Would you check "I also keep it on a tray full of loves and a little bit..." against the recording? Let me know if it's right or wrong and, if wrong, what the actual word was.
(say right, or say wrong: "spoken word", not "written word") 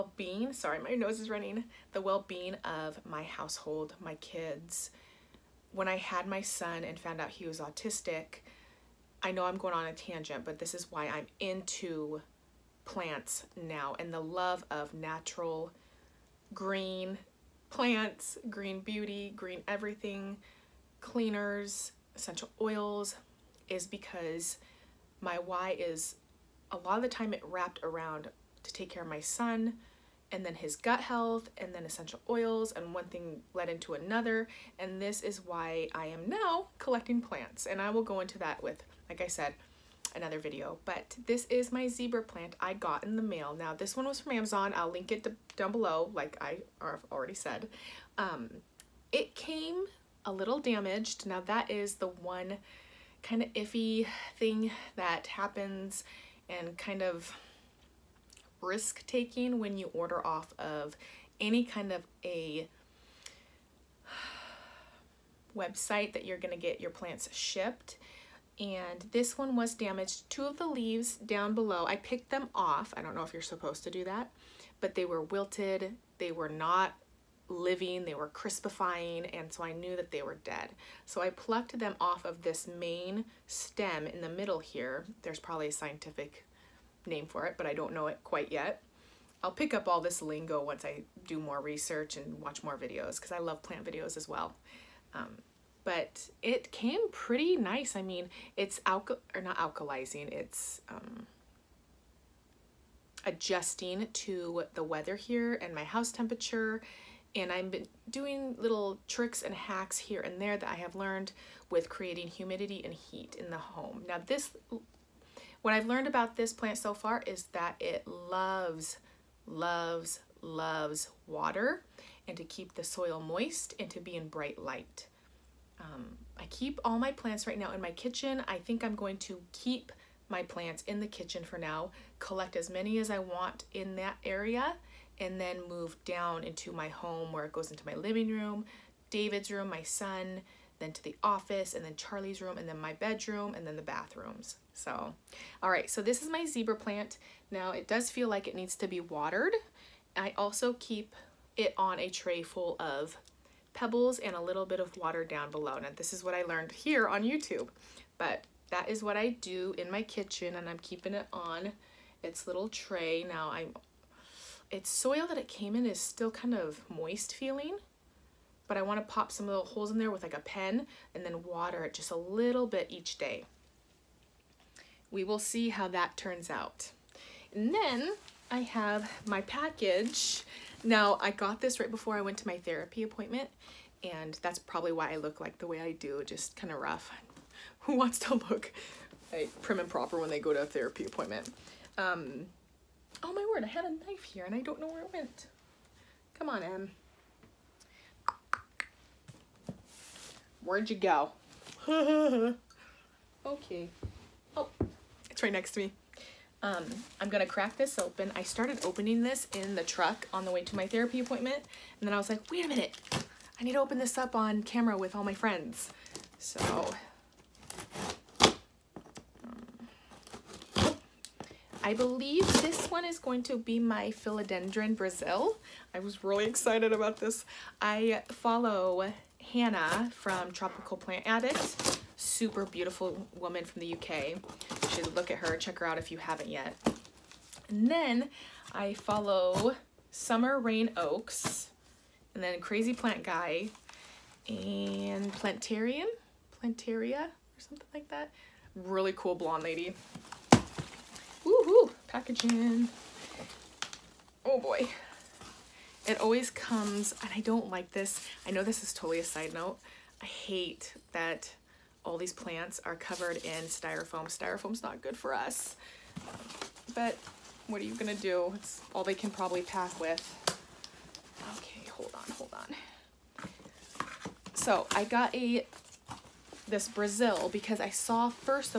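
wrong: "pebbles", not "loves".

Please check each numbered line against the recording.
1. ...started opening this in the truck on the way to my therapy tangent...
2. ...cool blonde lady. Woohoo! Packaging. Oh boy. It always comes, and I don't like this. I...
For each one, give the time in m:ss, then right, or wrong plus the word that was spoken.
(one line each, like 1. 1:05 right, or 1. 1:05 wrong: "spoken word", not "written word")
1. 3:28 wrong: "appointment", not "tangent"
2. 4:09 right.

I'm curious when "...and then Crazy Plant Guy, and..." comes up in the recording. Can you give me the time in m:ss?
4:02.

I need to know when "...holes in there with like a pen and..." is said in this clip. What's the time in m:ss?
2:49.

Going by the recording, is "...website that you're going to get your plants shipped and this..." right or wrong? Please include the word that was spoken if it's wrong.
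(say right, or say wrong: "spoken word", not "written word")
right.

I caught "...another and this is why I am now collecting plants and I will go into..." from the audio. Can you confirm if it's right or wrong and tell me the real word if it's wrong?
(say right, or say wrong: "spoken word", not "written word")
right.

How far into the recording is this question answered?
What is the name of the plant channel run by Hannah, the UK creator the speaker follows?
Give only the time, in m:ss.
3:50.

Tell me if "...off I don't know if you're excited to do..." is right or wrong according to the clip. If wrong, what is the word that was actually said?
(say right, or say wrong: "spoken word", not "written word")
wrong: "supposed", not "excited".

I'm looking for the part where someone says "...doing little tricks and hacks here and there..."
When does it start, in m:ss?
1:48.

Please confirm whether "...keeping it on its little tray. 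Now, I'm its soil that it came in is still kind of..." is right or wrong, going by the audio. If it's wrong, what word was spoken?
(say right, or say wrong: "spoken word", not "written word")
right.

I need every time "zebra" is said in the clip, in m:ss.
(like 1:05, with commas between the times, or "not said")
0:41, 2:26.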